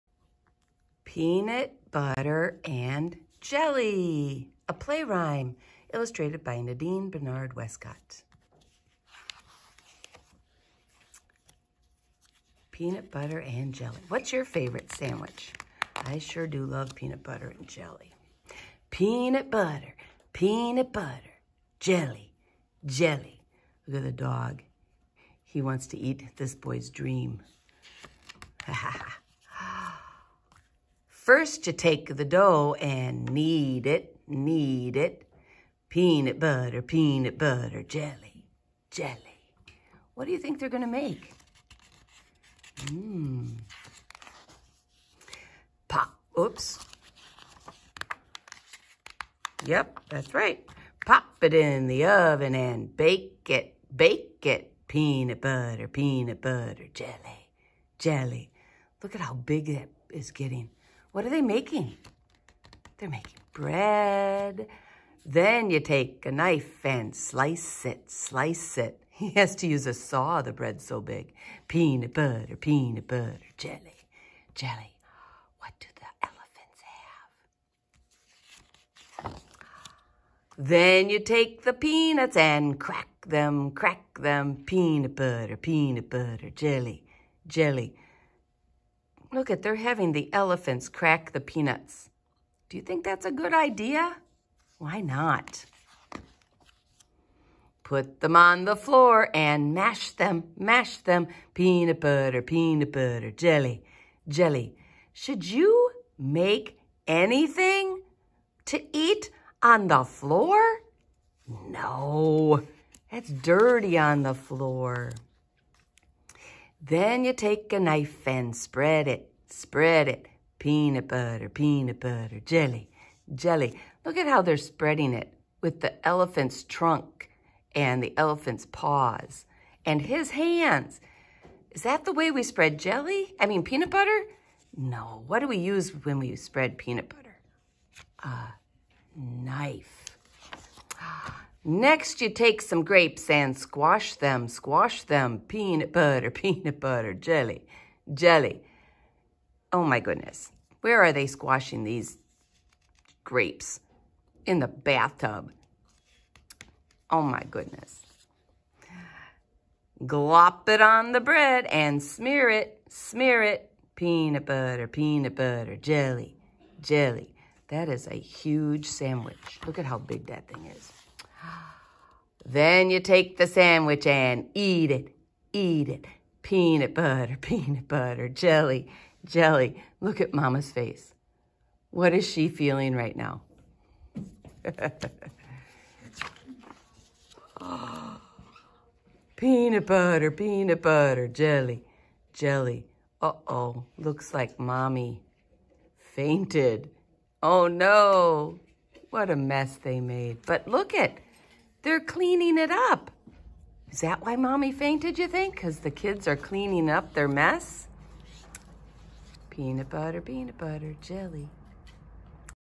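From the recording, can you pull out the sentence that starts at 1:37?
Put them on the floor and mash them, mash them.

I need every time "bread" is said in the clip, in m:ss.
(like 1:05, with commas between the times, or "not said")
1:03, 1:10, 2:41.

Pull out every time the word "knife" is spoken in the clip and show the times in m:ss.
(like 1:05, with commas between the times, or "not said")
1:06, 1:57, 2:19.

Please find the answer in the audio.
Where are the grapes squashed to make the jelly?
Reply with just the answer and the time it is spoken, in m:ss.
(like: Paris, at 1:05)
In the bathtub, at 2:34.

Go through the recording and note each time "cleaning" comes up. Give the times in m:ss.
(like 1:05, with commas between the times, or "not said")
3:21, 3:26.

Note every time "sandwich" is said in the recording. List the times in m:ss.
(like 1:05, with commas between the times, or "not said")
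0:14, 2:48, 2:53.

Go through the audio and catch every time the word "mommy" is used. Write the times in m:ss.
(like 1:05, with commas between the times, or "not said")
3:14, 3:24.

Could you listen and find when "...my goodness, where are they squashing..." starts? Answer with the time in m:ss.
2:29.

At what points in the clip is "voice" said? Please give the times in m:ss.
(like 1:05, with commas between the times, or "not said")
not said.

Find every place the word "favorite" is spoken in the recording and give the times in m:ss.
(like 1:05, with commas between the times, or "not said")
0:14.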